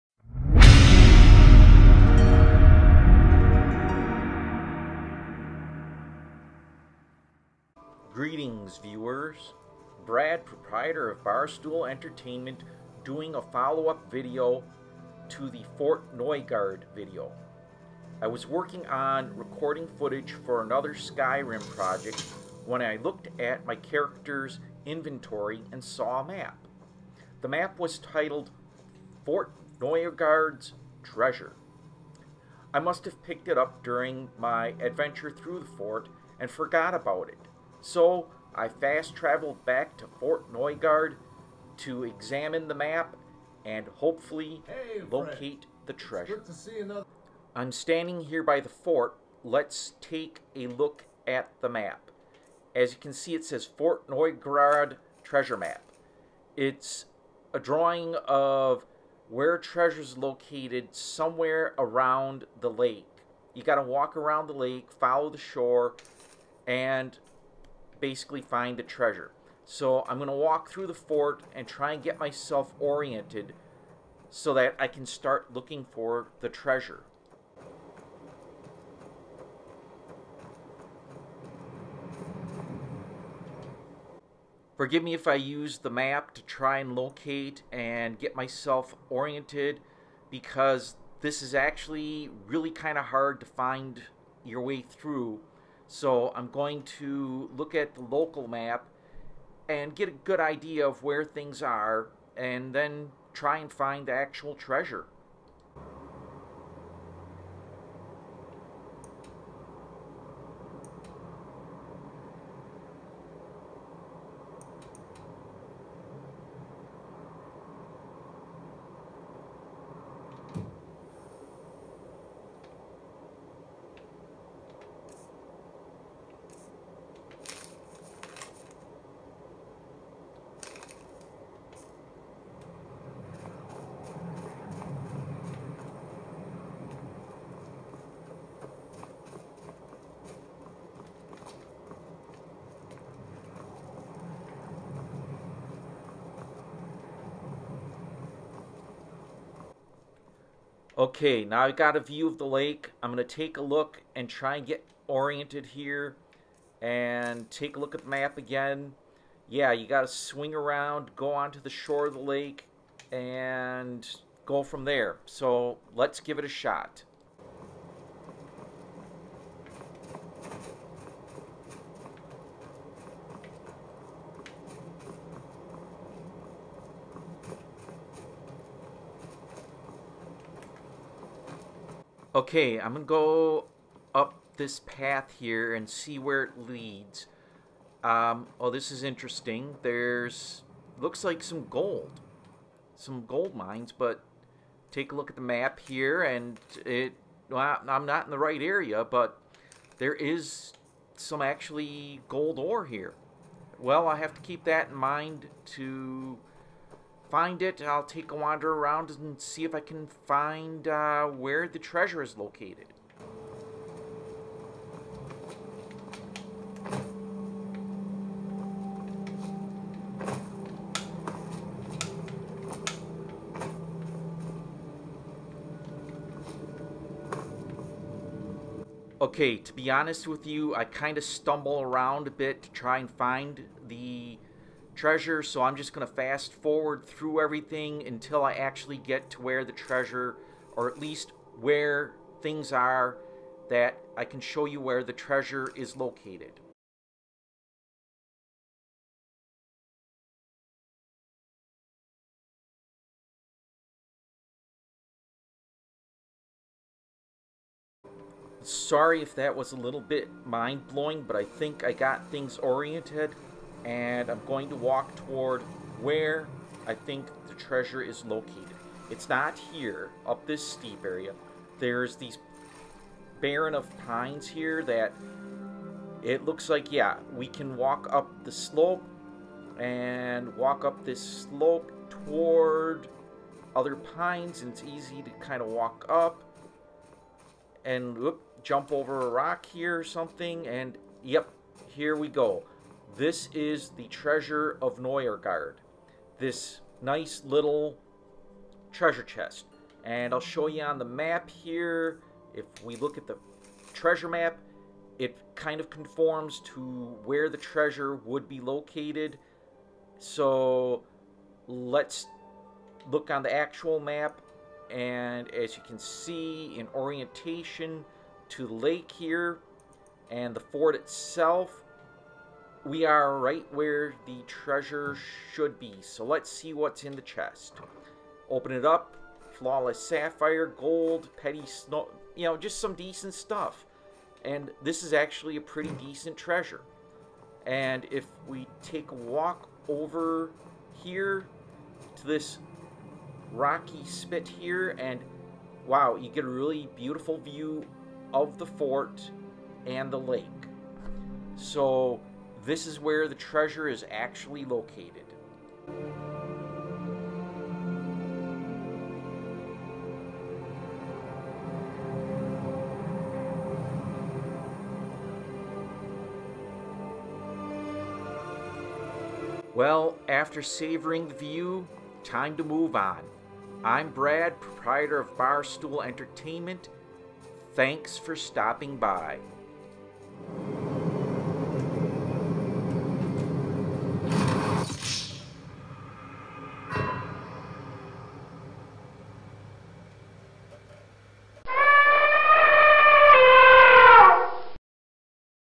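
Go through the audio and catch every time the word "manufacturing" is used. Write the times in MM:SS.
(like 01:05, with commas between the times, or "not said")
not said.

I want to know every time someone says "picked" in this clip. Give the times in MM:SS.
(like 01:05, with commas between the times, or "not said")
00:33.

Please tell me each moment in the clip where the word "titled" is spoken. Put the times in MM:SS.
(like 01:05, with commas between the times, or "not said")
00:27.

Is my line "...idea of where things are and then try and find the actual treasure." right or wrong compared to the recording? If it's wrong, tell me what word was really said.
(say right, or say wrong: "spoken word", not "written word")
right.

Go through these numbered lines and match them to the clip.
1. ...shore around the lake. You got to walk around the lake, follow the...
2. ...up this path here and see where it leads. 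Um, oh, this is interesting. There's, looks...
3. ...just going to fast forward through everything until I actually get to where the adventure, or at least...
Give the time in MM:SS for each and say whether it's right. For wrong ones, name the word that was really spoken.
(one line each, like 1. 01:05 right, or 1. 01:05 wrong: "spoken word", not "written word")
1. 01:00 wrong: "somewhere", not "shore"
2. 03:04 right
3. 03:55 wrong: "treasure", not "adventure".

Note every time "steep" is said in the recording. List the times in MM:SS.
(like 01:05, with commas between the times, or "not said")
04:30.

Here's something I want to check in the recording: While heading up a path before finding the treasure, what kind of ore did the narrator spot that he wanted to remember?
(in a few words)
Gold ore.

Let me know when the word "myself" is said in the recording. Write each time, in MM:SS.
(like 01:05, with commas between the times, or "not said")
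01:12, 01:28.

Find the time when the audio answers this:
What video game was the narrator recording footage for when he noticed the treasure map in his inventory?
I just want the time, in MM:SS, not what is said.
00:20.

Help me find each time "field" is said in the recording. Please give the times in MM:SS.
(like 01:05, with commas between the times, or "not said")
not said.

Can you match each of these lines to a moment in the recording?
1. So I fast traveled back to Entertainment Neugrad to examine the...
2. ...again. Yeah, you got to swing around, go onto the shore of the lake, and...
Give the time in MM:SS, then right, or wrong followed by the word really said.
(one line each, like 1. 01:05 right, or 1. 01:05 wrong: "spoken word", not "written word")
1. 00:37 wrong: "Fort", not "Entertainment"
2. 02:38 right.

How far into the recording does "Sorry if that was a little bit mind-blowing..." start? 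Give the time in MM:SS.
04:18.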